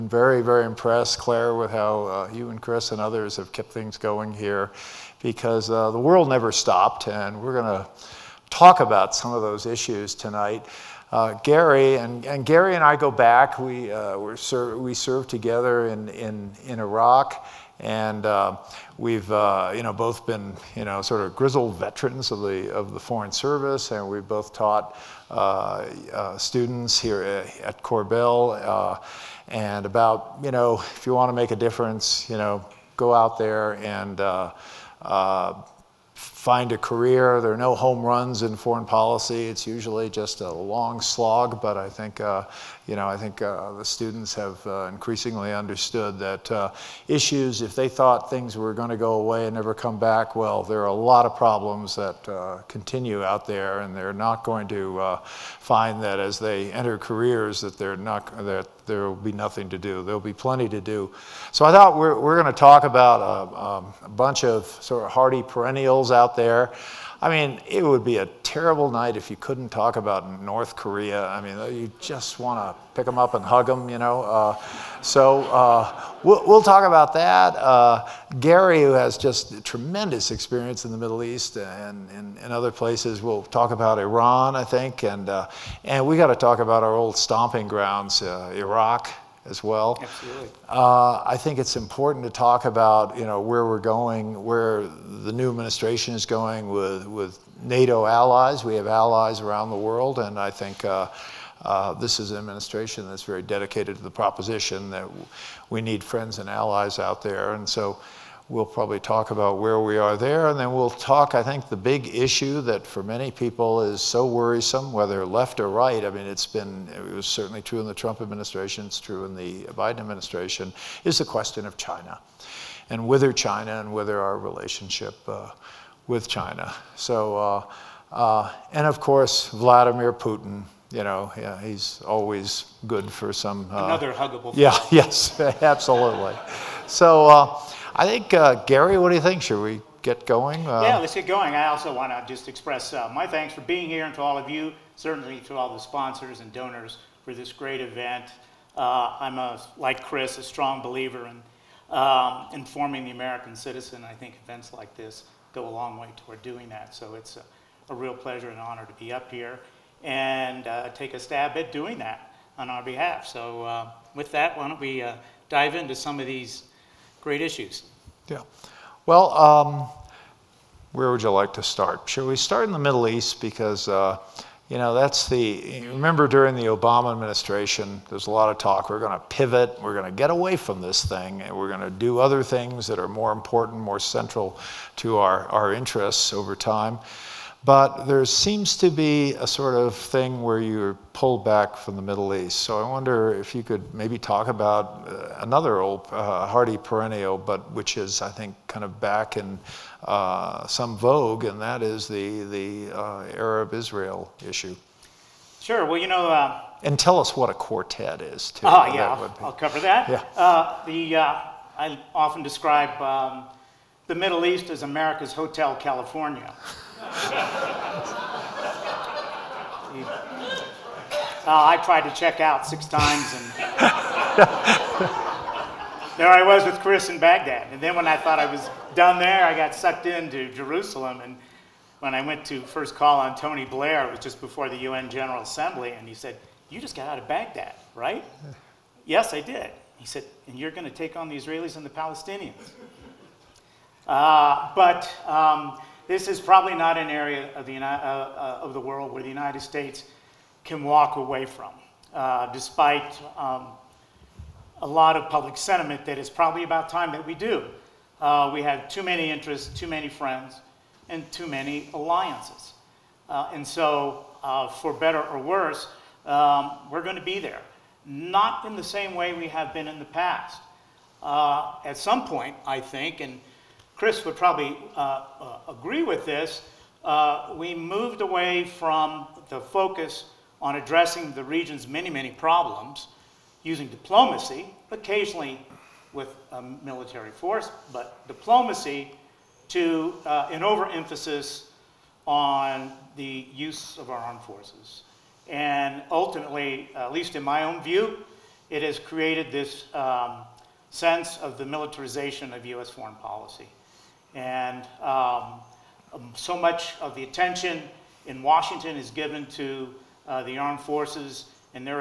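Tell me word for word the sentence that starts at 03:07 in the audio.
But there seems to be a sort of thing where you're pulled back from the Middle East.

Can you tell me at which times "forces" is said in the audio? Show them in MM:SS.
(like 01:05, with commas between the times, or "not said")
04:47, 04:54, 05:10.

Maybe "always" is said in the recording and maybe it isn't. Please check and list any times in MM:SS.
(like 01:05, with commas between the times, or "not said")
02:12.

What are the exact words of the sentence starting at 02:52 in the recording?
Should we start in the Middle East?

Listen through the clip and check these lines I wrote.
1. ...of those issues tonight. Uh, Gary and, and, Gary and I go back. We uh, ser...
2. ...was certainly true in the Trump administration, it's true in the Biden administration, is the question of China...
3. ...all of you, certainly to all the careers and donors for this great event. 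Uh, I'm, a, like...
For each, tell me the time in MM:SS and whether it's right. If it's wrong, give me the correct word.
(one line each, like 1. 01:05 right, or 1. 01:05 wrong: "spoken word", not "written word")
1. 00:09 right
2. 01:57 right
3. 02:24 wrong: "sponsors", not "careers".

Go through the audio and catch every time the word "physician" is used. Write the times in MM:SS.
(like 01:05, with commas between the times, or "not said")
not said.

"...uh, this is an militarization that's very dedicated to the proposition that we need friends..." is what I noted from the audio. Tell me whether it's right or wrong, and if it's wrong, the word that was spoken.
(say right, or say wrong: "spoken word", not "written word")
wrong: "administration", not "militarization".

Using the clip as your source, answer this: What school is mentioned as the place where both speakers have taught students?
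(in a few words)
Korbel.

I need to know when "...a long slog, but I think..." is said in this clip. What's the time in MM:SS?
00:40.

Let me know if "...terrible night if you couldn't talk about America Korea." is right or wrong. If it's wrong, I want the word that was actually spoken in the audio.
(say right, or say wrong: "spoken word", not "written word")
wrong: "North", not "America".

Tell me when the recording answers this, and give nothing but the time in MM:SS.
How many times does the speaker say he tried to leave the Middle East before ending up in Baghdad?
03:42.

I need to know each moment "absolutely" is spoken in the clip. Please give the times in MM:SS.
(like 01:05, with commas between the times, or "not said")
01:30, 02:15.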